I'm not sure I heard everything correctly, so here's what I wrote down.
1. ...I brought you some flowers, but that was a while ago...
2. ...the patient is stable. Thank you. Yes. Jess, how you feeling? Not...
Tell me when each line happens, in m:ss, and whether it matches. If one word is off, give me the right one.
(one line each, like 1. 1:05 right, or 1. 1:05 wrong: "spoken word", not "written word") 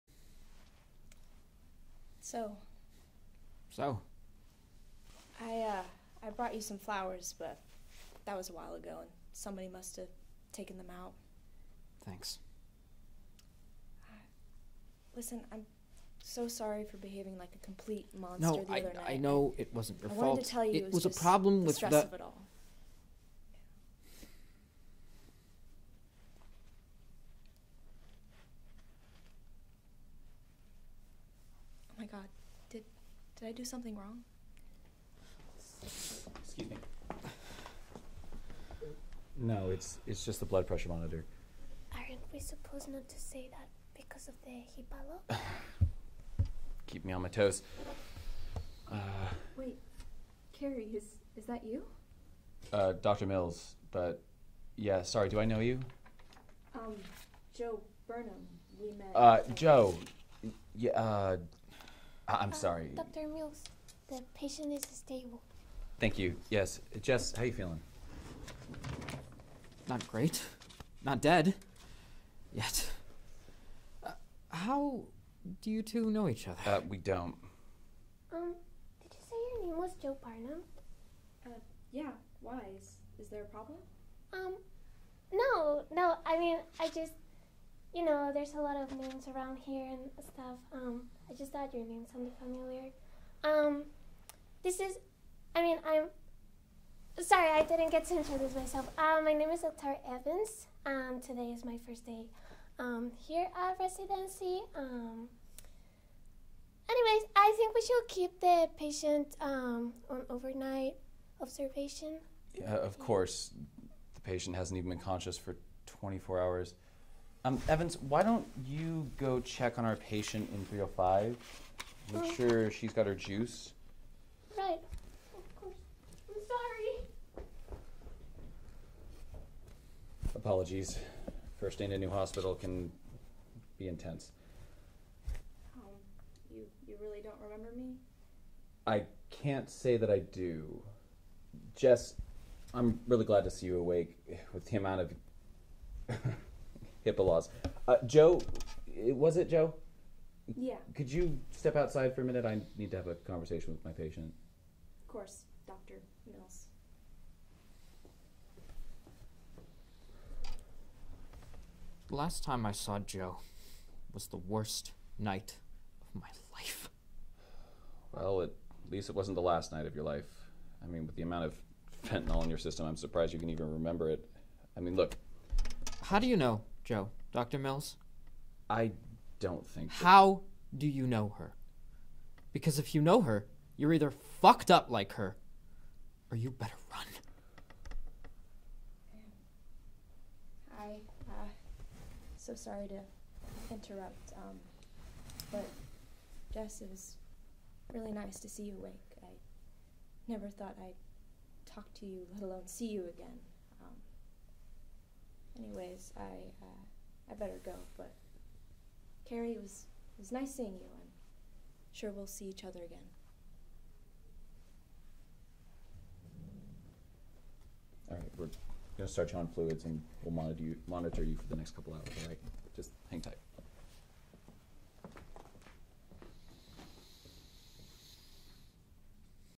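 1. 0:06 right
2. 1:04 right.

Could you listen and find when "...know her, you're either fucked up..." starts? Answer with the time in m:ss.
3:03.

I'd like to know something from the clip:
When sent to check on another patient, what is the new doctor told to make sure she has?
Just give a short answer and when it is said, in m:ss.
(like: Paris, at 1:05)
juice, at 2:03.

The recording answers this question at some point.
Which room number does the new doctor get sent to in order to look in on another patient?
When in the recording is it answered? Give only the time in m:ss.
2:00.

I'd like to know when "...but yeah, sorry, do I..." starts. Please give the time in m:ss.
0:53.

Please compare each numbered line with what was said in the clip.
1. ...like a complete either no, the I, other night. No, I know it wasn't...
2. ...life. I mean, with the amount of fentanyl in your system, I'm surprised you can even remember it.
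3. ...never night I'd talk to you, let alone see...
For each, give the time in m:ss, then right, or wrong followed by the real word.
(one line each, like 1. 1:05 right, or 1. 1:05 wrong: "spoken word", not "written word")
1. 0:17 wrong: "monster", not "either"
2. 2:50 right
3. 3:20 wrong: "thought", not "night".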